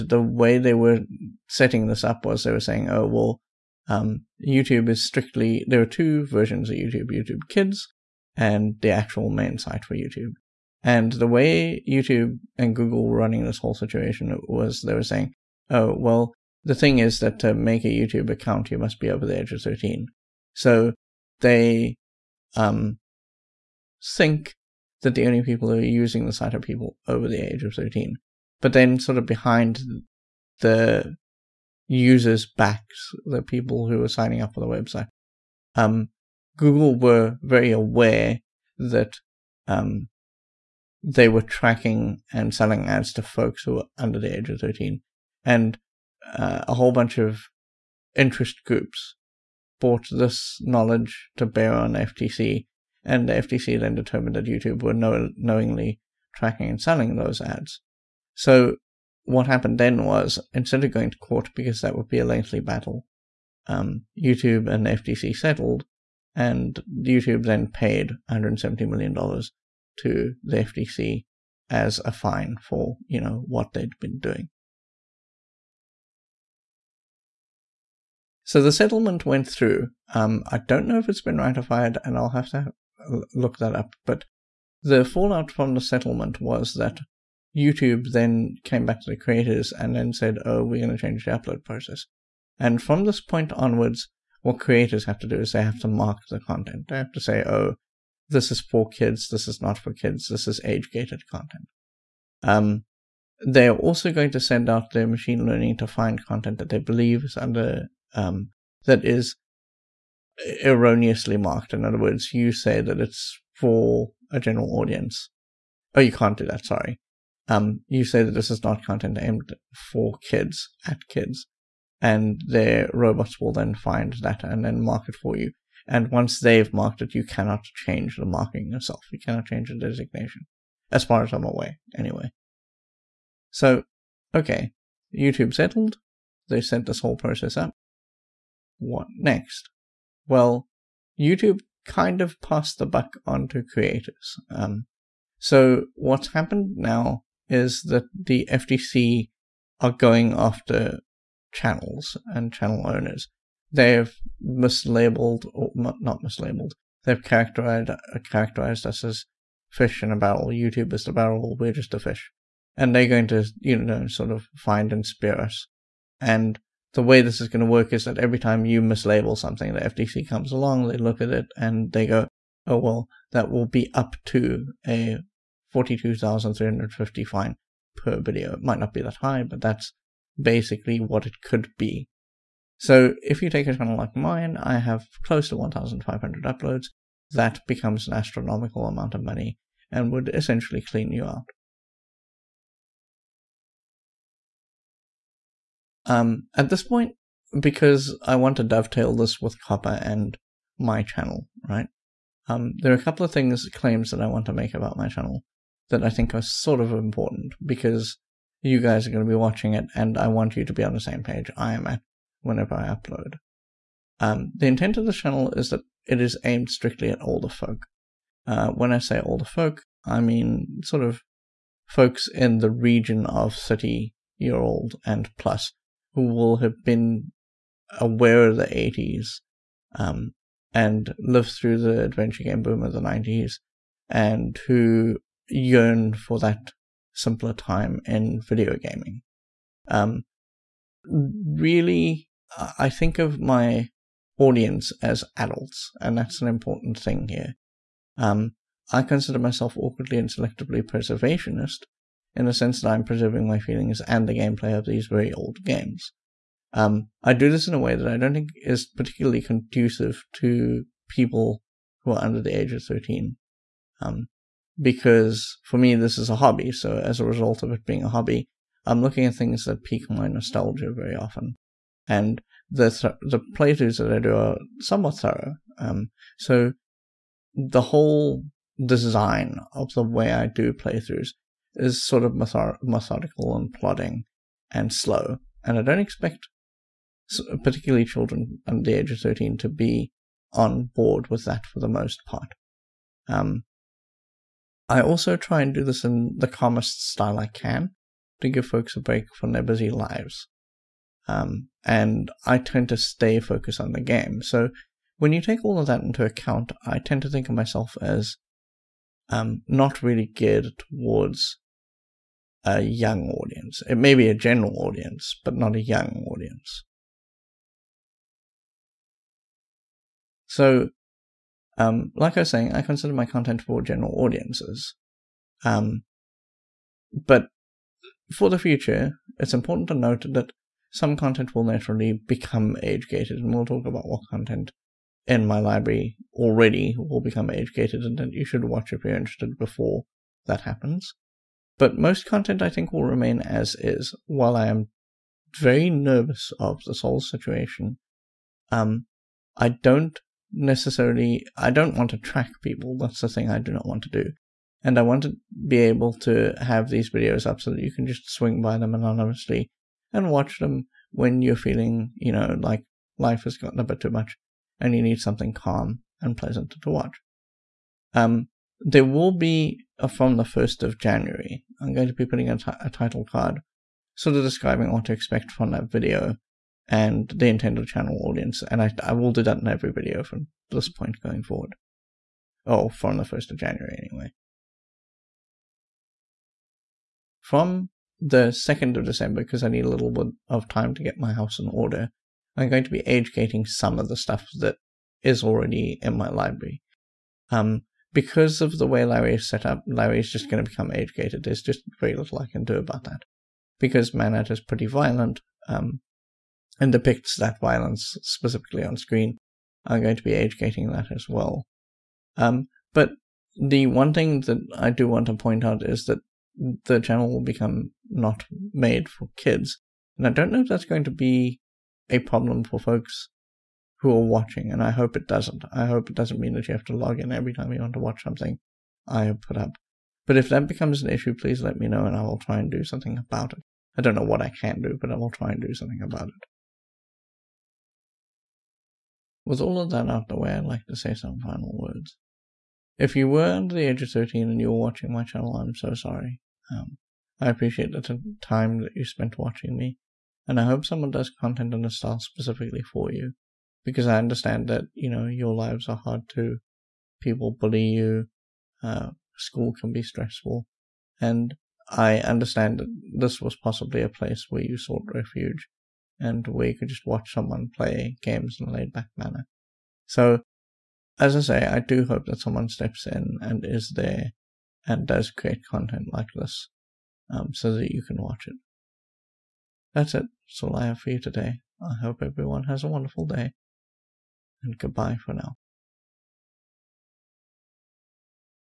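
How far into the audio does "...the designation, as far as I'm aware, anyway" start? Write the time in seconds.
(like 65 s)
129 s.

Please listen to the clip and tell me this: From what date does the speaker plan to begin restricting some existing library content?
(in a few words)
2nd of December.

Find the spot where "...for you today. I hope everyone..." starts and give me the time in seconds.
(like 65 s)
481 s.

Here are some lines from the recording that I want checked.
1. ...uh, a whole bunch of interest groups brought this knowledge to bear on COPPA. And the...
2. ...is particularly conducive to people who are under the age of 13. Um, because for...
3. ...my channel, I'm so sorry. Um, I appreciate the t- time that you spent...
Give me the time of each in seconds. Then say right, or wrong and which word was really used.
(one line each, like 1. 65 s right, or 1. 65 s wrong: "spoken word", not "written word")
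1. 46 s wrong: "FTC", not "COPPA"
2. 258 s right
3. 445 s right.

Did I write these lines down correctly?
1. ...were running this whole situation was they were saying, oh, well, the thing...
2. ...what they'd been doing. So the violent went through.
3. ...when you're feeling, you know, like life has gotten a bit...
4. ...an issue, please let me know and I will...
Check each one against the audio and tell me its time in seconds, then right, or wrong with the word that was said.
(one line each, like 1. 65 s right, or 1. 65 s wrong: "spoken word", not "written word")
1. 13 s right
2. 73 s wrong: "settlement", not "violent"
3. 361 s right
4. 431 s right.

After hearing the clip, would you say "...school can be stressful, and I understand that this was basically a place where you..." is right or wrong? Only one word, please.
wrong.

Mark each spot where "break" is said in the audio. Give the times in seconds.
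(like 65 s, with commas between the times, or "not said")
299 s.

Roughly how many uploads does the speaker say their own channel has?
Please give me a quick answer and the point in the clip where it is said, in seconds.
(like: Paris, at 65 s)
1,500, at 185 s.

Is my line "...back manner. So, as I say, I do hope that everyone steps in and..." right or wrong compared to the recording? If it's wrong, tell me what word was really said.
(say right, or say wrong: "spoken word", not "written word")
wrong: "someone", not "everyone".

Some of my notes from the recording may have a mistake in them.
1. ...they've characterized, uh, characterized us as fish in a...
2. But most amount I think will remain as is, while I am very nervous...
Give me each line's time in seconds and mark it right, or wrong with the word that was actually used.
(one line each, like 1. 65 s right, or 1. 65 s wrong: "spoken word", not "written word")
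1. 157 s right
2. 341 s wrong: "content", not "amount".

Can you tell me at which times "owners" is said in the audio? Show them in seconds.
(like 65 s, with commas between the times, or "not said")
152 s.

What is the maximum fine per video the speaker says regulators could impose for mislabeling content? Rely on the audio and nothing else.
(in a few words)
42,350.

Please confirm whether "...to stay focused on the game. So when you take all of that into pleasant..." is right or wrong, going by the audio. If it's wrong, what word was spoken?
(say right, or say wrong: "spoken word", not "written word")
wrong: "account", not "pleasant".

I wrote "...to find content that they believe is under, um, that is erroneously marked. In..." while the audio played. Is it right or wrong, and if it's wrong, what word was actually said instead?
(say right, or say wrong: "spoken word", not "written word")
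right.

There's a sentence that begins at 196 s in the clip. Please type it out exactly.
Um, at this point, because I want to dovetail this with COPPA and my channel, right?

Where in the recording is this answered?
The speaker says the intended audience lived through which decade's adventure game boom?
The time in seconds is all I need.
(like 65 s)
232 s.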